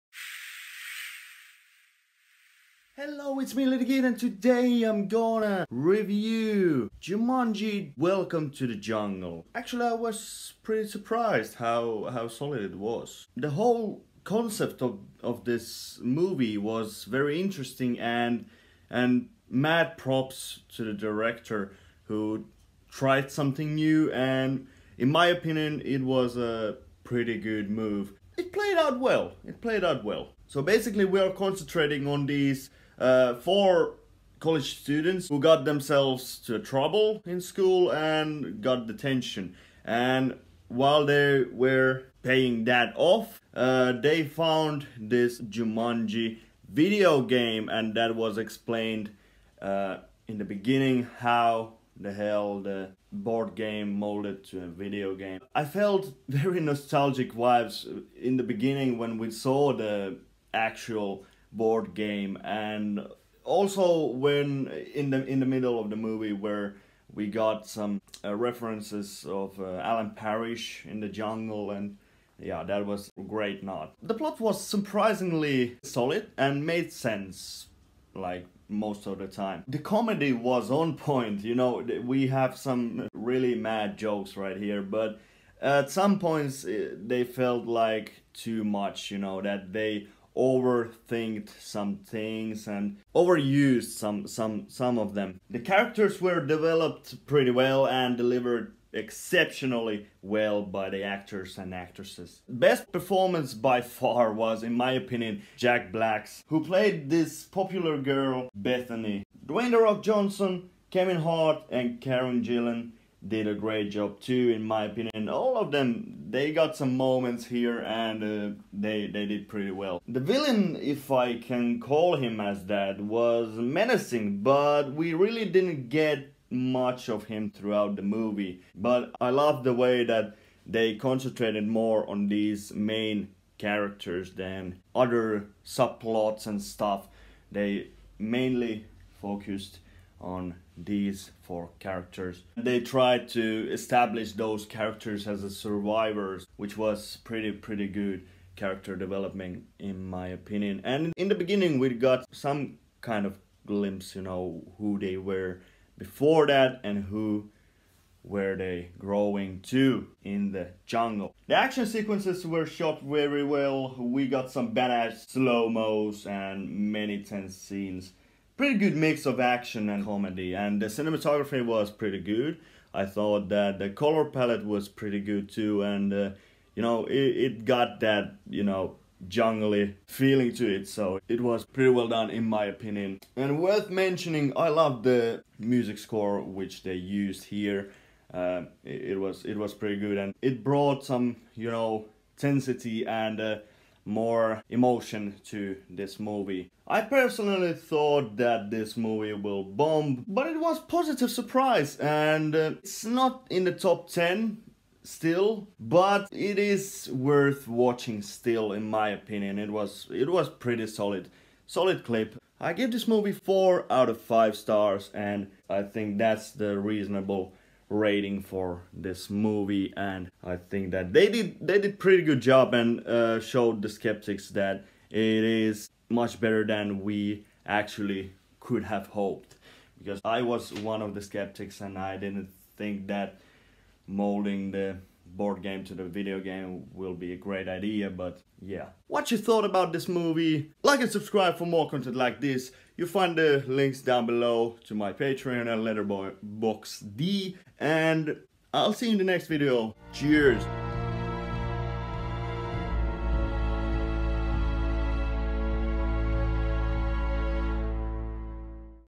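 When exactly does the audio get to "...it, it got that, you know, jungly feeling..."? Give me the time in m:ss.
2:57.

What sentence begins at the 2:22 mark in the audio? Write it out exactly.
They tried to establish those characters as survivors, which was pretty, pretty good character development in my opinion.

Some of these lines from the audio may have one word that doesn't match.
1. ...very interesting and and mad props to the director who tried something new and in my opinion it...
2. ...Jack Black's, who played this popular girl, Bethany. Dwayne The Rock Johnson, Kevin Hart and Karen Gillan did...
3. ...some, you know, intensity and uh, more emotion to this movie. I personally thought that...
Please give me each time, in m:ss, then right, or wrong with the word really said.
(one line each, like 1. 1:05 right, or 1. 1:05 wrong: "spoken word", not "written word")
1. 0:17 right
2. 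1:45 right
3. 3:11 right.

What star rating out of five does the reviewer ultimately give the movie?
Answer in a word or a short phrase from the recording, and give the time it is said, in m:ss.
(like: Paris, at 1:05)
4 out of 5, at 3:33.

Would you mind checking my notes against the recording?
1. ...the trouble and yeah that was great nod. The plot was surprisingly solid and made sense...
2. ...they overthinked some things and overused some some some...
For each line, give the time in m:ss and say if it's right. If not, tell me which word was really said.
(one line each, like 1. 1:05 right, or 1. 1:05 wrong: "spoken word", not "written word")
1. 1:11 wrong: "jungle", not "trouble"
2. 1:29 right.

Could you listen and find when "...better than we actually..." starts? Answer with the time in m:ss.
3:46.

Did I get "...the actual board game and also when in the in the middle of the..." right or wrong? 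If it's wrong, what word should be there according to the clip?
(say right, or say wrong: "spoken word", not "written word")
right.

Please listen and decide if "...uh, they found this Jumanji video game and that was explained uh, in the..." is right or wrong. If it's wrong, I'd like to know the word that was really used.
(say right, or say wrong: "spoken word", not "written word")
right.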